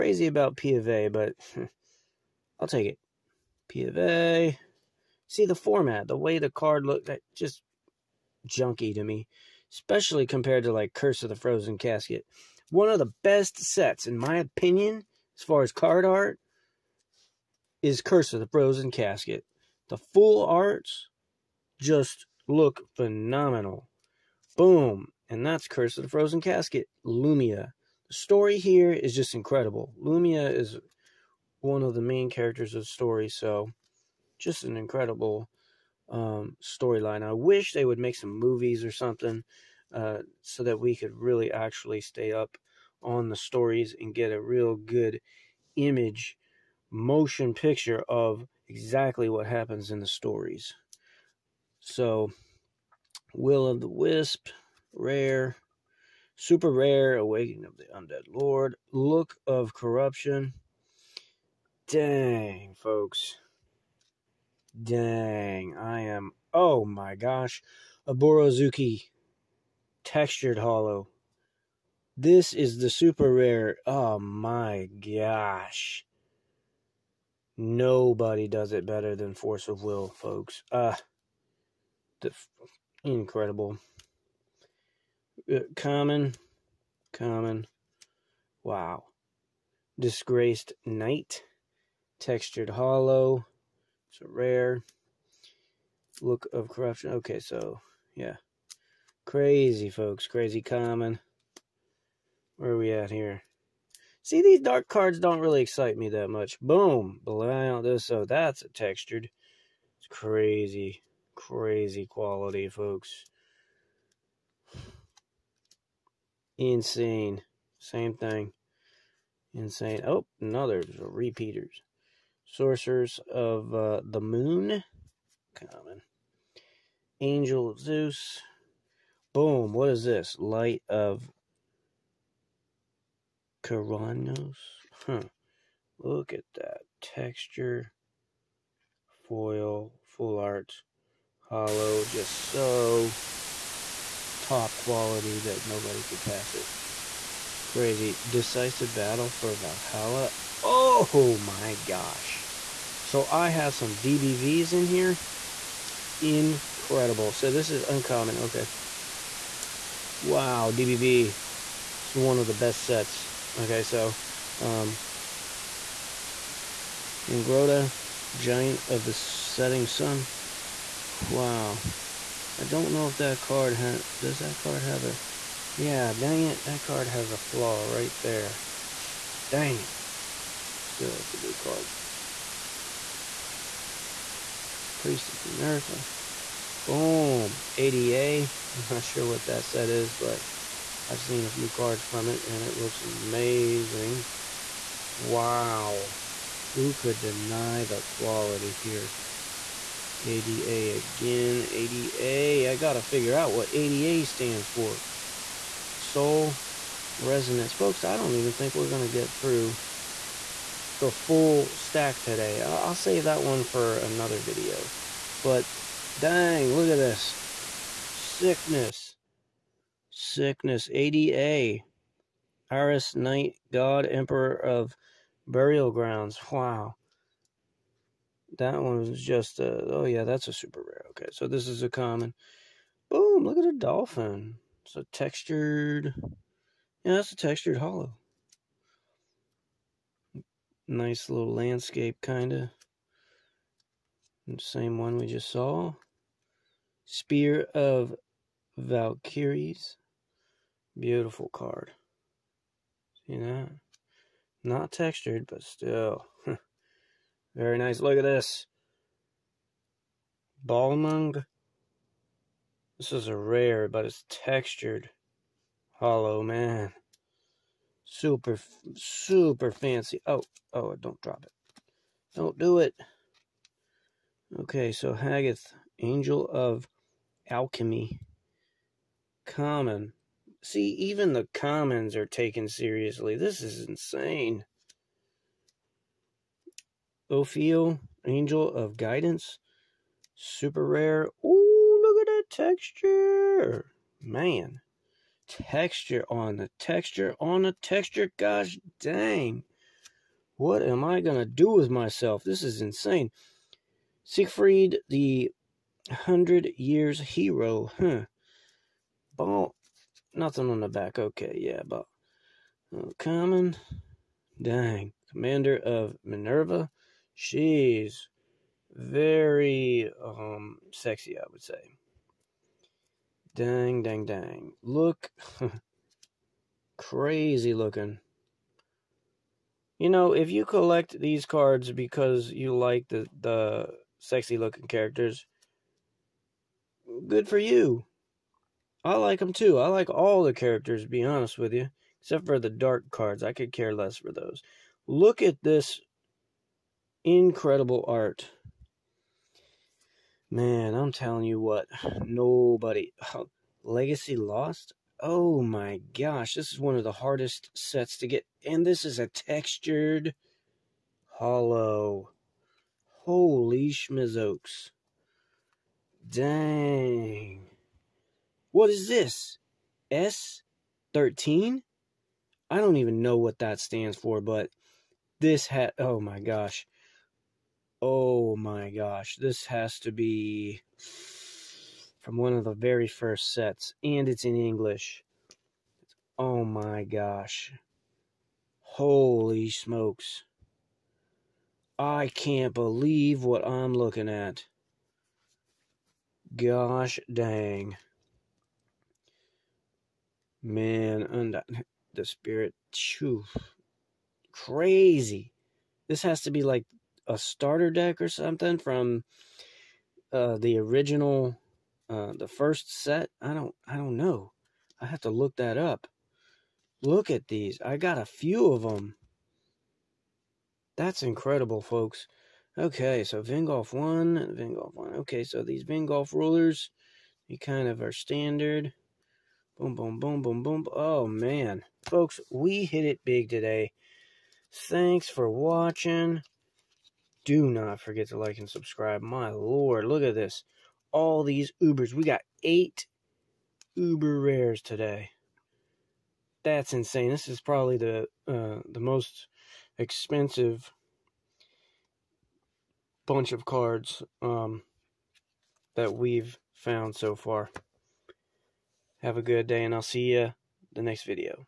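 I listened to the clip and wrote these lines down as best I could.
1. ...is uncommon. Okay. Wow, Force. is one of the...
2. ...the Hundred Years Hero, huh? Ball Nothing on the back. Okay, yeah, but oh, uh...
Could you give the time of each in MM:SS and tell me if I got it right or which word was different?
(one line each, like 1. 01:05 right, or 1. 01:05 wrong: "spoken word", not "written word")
1. 02:37 wrong: "DBV", not "Force"
2. 05:05 right.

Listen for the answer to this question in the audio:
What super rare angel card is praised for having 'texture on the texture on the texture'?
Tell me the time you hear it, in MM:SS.
04:47.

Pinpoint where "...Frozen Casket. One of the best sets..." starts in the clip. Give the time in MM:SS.
00:11.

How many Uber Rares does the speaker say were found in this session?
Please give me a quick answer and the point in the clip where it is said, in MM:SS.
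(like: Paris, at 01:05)
8, at 07:22.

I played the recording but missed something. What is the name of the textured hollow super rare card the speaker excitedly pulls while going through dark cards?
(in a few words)
Borozuki.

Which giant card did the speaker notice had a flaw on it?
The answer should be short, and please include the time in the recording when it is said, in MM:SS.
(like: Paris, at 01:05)
Ingrota, Giant of the Setting Sun, at 02:47.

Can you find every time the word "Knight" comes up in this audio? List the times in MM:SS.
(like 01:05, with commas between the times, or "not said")
01:30, 03:43.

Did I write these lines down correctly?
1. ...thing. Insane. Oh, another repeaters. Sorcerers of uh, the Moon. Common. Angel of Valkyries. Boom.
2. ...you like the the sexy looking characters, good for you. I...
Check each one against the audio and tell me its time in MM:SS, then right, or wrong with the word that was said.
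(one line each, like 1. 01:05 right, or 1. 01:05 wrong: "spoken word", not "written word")
1. 01:58 wrong: "Zeus", not "Valkyries"
2. 05:32 right.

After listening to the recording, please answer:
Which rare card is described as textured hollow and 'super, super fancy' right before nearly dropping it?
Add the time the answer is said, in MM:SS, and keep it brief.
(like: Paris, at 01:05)
Balmung, at 04:20.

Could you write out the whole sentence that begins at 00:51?
So, Will of the Wisp, Rare, Super Rare, Awakening of the Undead Lord, Look of Corruption.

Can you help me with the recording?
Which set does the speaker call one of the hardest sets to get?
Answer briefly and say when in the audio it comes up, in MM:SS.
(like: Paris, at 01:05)
Legacy Lost, at 05:53.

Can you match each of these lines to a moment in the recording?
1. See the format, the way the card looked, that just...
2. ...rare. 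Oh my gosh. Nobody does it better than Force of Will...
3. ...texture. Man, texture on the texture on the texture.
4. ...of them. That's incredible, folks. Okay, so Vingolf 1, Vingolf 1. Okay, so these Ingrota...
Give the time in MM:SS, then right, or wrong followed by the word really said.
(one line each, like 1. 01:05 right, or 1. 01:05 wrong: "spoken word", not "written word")
1. 00:05 right
2. 01:13 right
3. 04:52 right
4. 06:58 wrong: "Vingolf", not "Ingrota".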